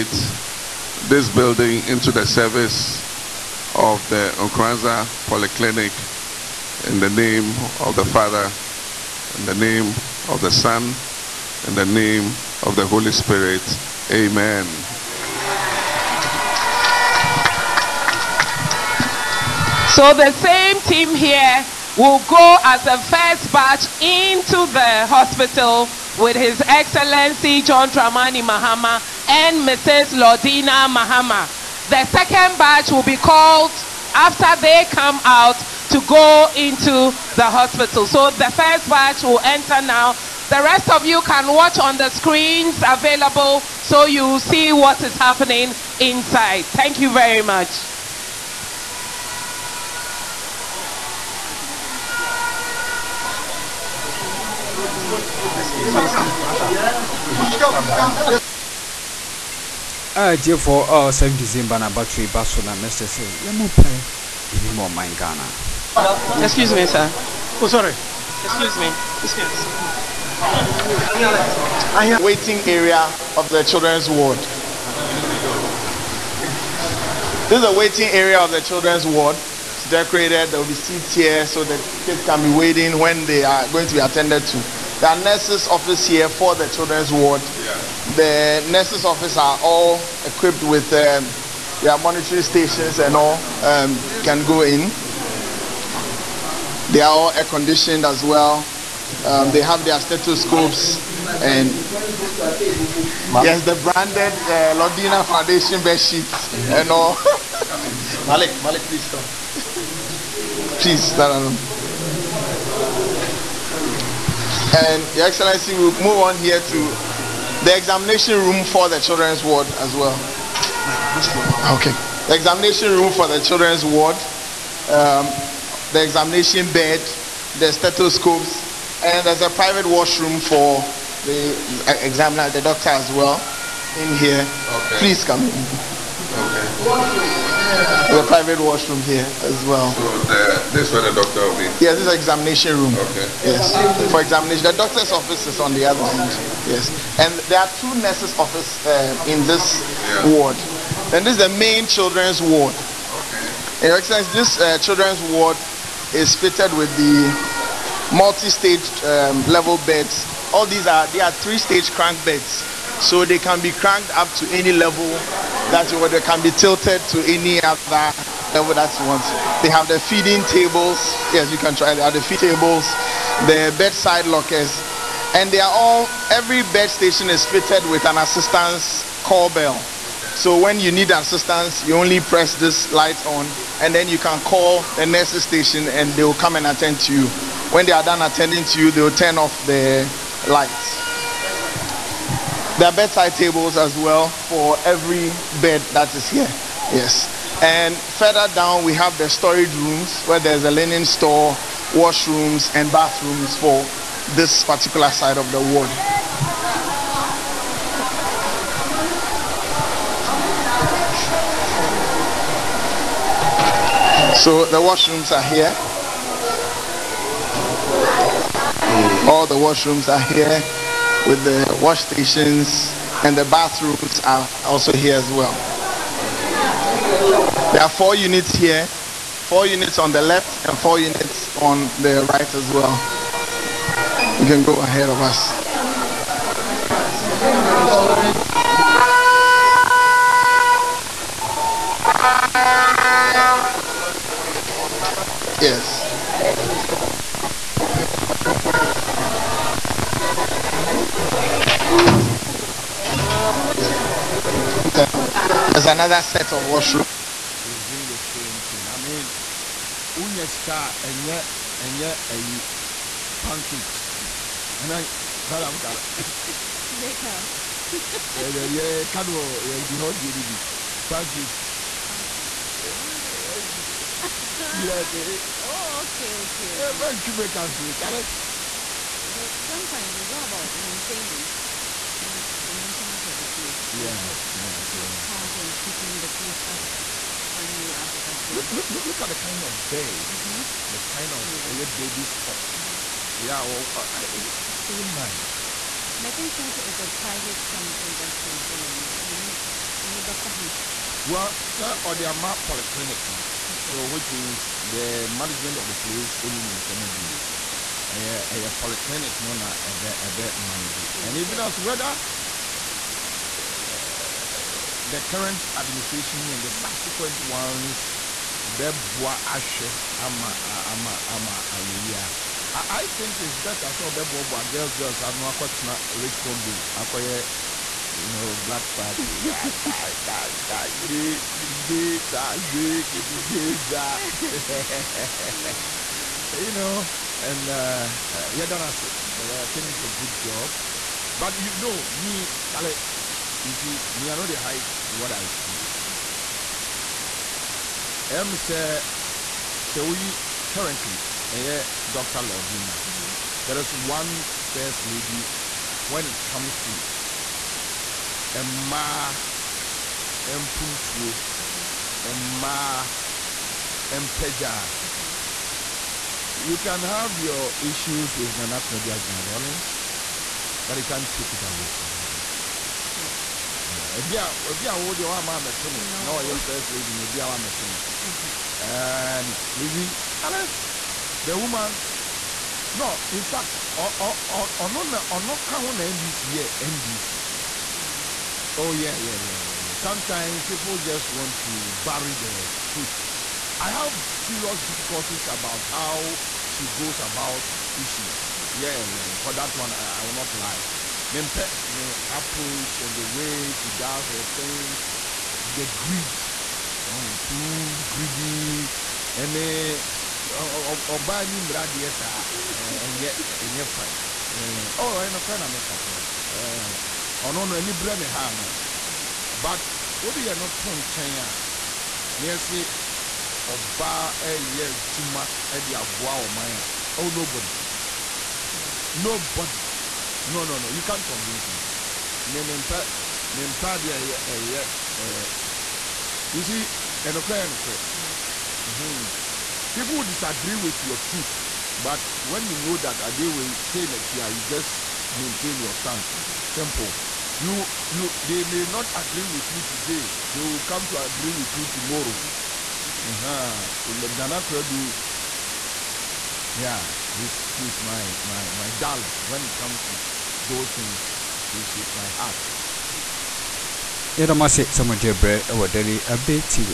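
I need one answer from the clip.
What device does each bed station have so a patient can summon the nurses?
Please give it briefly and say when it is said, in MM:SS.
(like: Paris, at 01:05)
assistance call bell, at 02:58.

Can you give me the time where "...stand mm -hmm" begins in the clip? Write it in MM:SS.
07:25.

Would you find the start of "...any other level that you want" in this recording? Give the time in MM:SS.
02:47.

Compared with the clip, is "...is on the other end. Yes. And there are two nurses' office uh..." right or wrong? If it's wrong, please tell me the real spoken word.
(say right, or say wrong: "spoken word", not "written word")
right.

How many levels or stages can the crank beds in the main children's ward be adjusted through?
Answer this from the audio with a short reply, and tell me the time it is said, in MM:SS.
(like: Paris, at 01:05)
3, at 02:41.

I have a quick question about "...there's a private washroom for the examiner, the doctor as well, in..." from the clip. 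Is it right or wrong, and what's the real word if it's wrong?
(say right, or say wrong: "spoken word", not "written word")
right.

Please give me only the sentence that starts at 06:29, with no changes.
Sometimes people just want to bury the truth.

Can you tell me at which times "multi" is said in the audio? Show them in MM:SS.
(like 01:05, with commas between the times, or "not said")
02:38.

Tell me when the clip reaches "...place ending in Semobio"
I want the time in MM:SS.
05:05.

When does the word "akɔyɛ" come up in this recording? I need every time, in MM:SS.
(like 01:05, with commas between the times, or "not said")
05:26.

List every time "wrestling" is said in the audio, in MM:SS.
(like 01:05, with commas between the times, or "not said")
not said.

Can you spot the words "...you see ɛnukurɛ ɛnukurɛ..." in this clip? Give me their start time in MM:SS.
07:16.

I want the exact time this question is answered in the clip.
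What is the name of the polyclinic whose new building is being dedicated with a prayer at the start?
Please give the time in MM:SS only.
00:04.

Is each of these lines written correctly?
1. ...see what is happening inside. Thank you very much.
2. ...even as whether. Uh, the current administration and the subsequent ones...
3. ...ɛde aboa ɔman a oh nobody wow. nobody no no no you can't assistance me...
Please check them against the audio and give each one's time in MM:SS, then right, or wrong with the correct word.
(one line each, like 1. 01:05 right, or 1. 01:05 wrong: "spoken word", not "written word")
1. 00:44 right
2. 05:11 right
3. 07:05 wrong: "convince", not "assistance".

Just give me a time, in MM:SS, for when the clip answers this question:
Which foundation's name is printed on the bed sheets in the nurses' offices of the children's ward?
01:44.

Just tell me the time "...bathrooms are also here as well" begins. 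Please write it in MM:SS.
03:43.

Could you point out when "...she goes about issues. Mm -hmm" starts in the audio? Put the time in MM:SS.
06:36.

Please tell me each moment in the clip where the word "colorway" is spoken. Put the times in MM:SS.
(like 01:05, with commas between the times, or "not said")
not said.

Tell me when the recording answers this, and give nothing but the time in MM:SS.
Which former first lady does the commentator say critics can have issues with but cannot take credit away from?
06:08.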